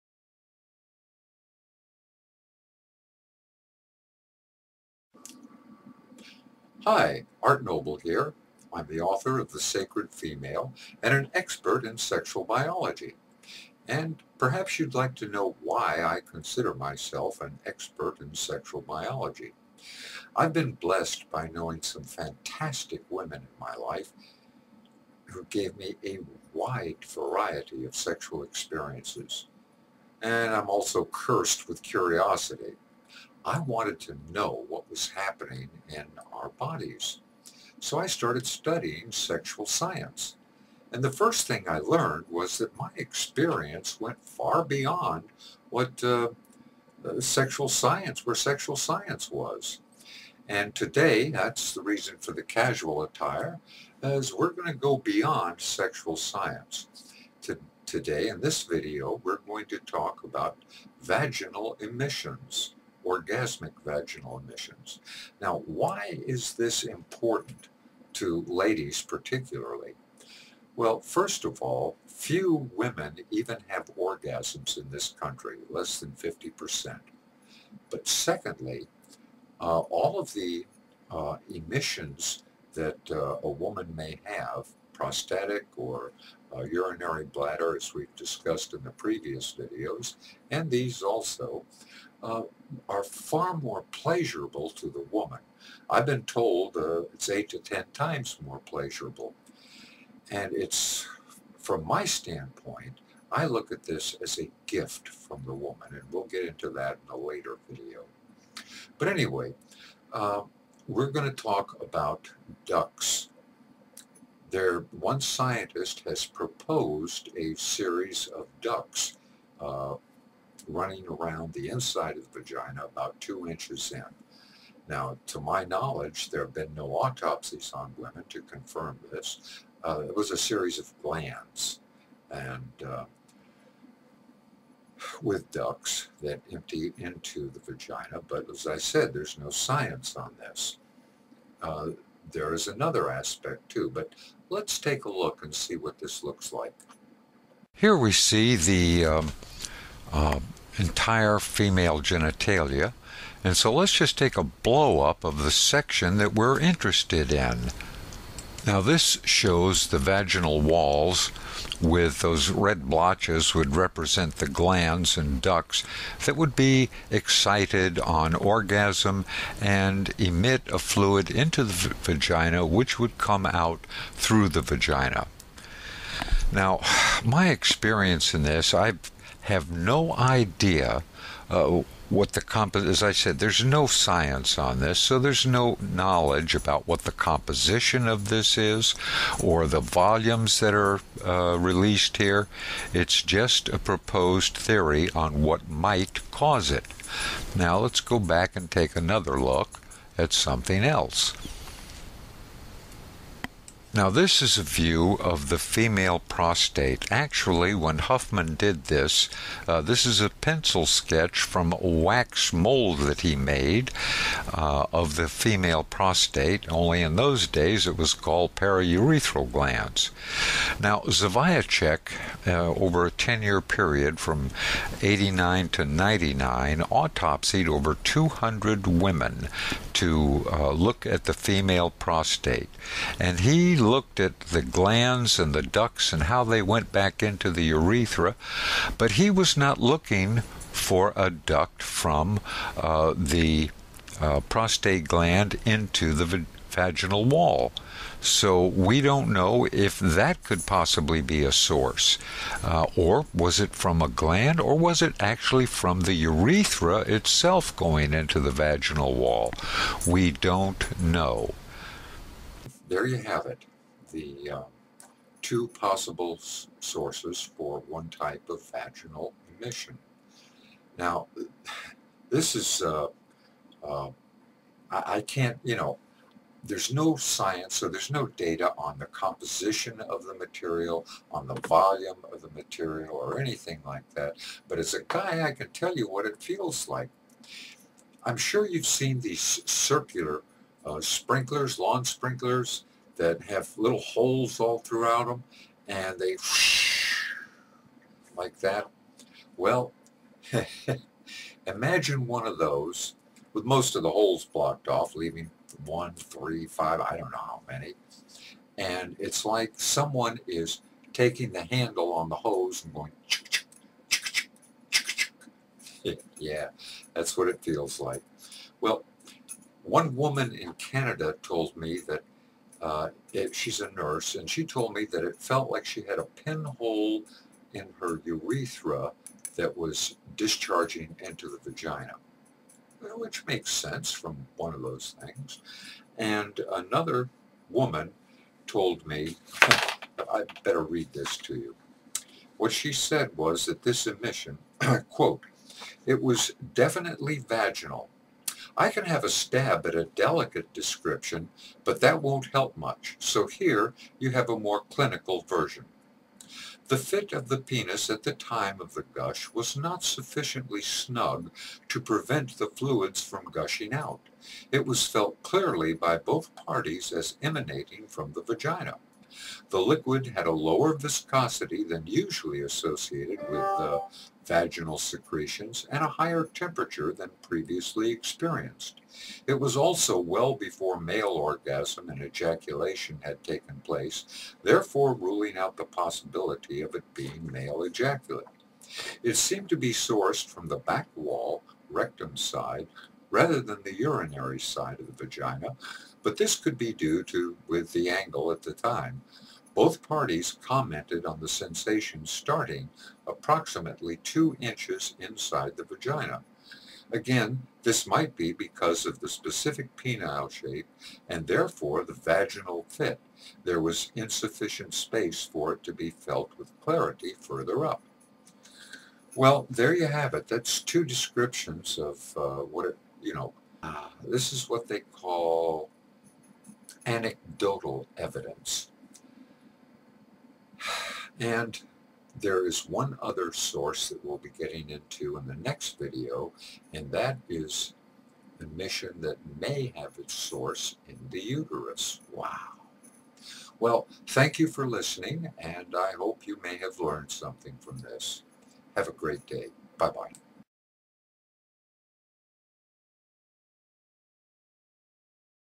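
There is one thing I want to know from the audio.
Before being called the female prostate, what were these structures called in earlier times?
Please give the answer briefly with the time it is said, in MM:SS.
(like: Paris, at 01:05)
periurethral glands, at 03:38.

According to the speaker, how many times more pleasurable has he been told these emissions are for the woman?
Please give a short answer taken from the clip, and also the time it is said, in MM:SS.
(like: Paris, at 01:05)
8 to 10, at 01:37.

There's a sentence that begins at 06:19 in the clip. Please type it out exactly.
It was also well before male orgasm and ejaculation had taken place, therefore ruling out the possibility of it being male ejaculate.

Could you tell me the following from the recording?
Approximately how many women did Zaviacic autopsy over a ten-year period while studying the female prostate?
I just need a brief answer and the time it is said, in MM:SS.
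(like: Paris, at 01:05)
over 200, at 03:47.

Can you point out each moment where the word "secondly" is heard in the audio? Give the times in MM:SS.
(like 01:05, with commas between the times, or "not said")
01:18.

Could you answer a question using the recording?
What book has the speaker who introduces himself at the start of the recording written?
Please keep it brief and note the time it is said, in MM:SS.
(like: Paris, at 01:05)
The Sacred Female, at 00:09.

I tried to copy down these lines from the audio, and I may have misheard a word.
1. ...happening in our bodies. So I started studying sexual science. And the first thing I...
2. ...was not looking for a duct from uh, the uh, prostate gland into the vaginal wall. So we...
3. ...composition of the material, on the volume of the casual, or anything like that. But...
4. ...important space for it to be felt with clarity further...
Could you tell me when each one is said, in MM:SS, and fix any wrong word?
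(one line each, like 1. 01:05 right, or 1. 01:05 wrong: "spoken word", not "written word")
1. 00:35 right
2. 03:59 right
3. 04:39 wrong: "material", not "casual"
4. 06:54 wrong: "insufficient", not "important".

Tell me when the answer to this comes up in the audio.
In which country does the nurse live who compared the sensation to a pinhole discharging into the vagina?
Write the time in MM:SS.
05:20.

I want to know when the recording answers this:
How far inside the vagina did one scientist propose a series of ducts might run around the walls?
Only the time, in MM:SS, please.
02:02.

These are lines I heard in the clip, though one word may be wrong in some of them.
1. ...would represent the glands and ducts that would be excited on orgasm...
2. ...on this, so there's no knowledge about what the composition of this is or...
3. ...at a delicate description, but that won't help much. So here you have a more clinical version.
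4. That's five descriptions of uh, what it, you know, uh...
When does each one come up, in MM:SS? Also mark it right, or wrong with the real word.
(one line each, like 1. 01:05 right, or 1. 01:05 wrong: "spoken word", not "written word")
1. 02:43 right
2. 03:04 right
3. 05:49 right
4. 07:00 wrong: "two", not "five".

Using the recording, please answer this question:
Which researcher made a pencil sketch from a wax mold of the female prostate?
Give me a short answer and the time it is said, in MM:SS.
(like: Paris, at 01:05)
Huffman, at 03:27.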